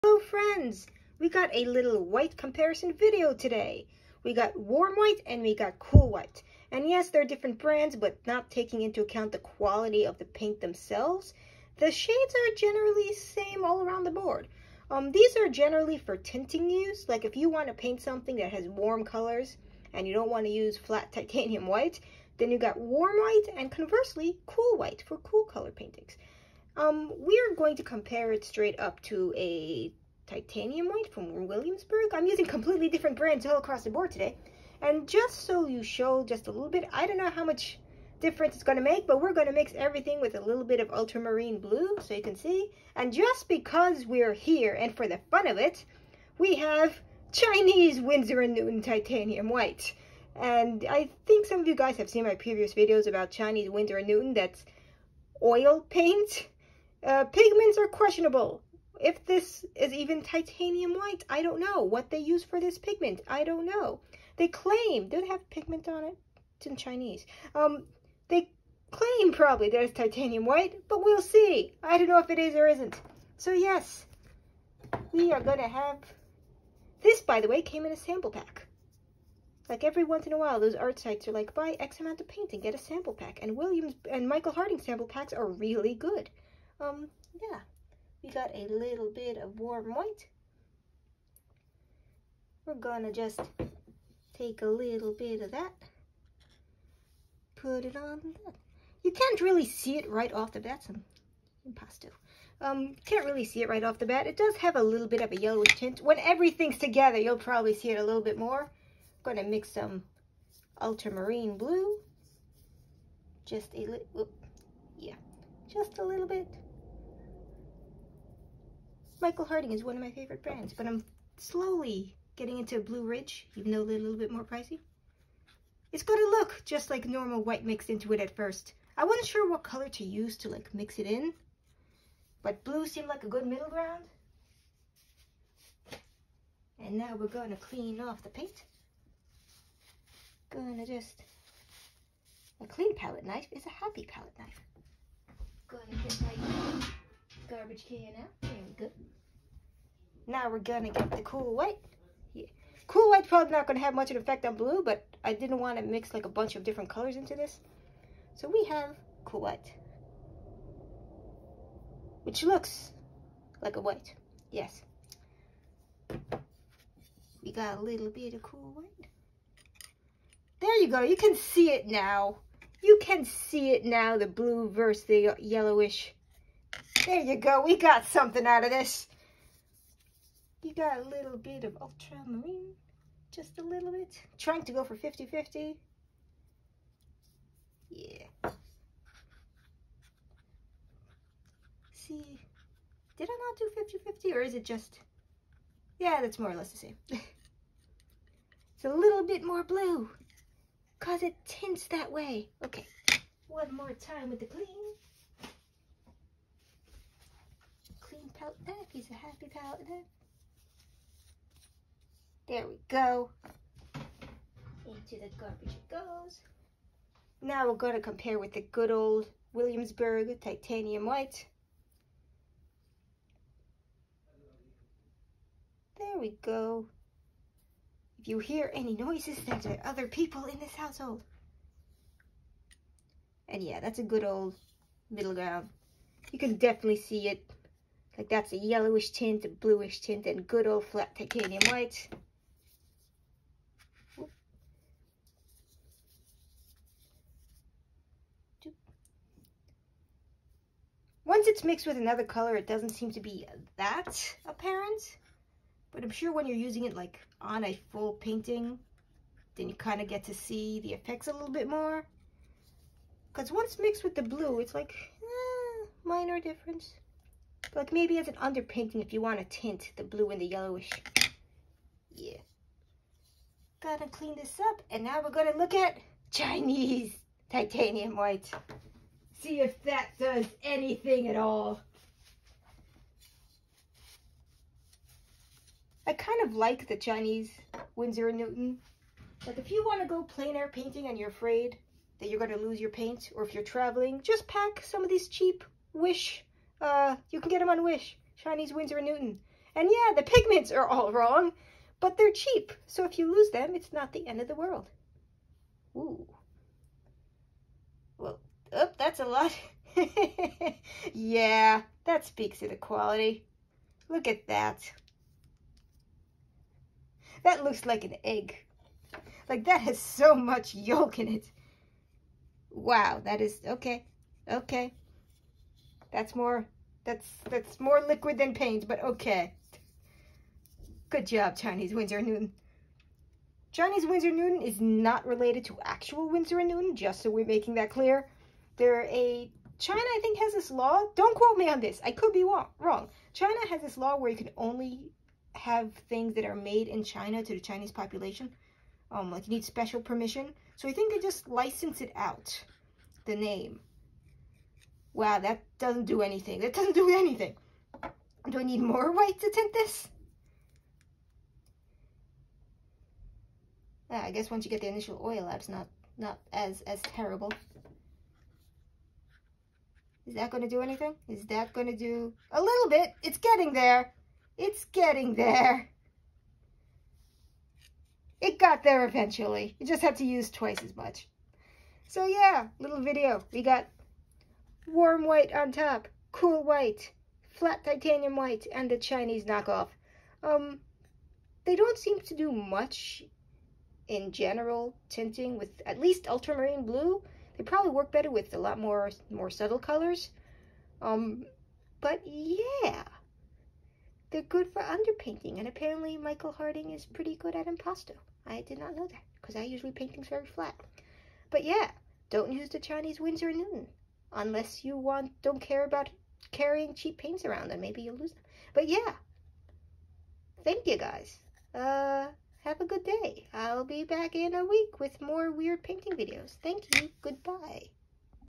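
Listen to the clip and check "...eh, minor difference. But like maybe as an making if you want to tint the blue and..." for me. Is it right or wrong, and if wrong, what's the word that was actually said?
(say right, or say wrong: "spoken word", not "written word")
wrong: "underpainting", not "making".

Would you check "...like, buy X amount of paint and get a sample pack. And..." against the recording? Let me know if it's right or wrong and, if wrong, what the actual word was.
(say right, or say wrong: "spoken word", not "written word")
right.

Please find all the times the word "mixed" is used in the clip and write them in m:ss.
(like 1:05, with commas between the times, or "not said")
2:07, 4:11, 4:23.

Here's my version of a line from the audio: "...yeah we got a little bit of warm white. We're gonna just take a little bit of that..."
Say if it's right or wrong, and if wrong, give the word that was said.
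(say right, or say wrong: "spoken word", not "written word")
right.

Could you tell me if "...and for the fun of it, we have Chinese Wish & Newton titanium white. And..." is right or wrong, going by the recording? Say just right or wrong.
wrong.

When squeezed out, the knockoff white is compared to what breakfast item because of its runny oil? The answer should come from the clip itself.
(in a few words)
An egg.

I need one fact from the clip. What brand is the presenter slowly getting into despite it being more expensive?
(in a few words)
Blue Ridge.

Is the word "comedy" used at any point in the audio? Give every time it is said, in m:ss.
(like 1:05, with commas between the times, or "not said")
not said.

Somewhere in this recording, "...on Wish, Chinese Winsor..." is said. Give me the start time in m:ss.
4:57.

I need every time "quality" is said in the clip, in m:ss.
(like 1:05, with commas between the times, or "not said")
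0:09, 5:12.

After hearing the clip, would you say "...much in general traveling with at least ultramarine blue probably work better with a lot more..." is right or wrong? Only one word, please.
wrong.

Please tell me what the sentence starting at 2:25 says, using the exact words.
Gonna get my garbage can out, there we go.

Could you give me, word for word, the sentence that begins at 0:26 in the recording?
Um, we're going to compare it straight up to a titanium white from Williamsburg.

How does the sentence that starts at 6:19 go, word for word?
You just have to use twice as much.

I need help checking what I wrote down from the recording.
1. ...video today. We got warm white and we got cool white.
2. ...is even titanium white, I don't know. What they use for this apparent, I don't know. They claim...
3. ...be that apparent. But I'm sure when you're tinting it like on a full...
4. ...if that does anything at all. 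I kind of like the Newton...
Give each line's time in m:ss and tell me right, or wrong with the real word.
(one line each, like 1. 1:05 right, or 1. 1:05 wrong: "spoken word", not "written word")
1. 0:02 right
2. 0:59 wrong: "pigment", not "apparent"
3. 4:13 wrong: "using", not "tinting"
4. 4:39 wrong: "Chinese", not "Newton".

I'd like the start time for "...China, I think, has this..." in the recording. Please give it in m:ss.
5:39.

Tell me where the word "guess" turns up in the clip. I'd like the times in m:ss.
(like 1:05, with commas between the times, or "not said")
6:04.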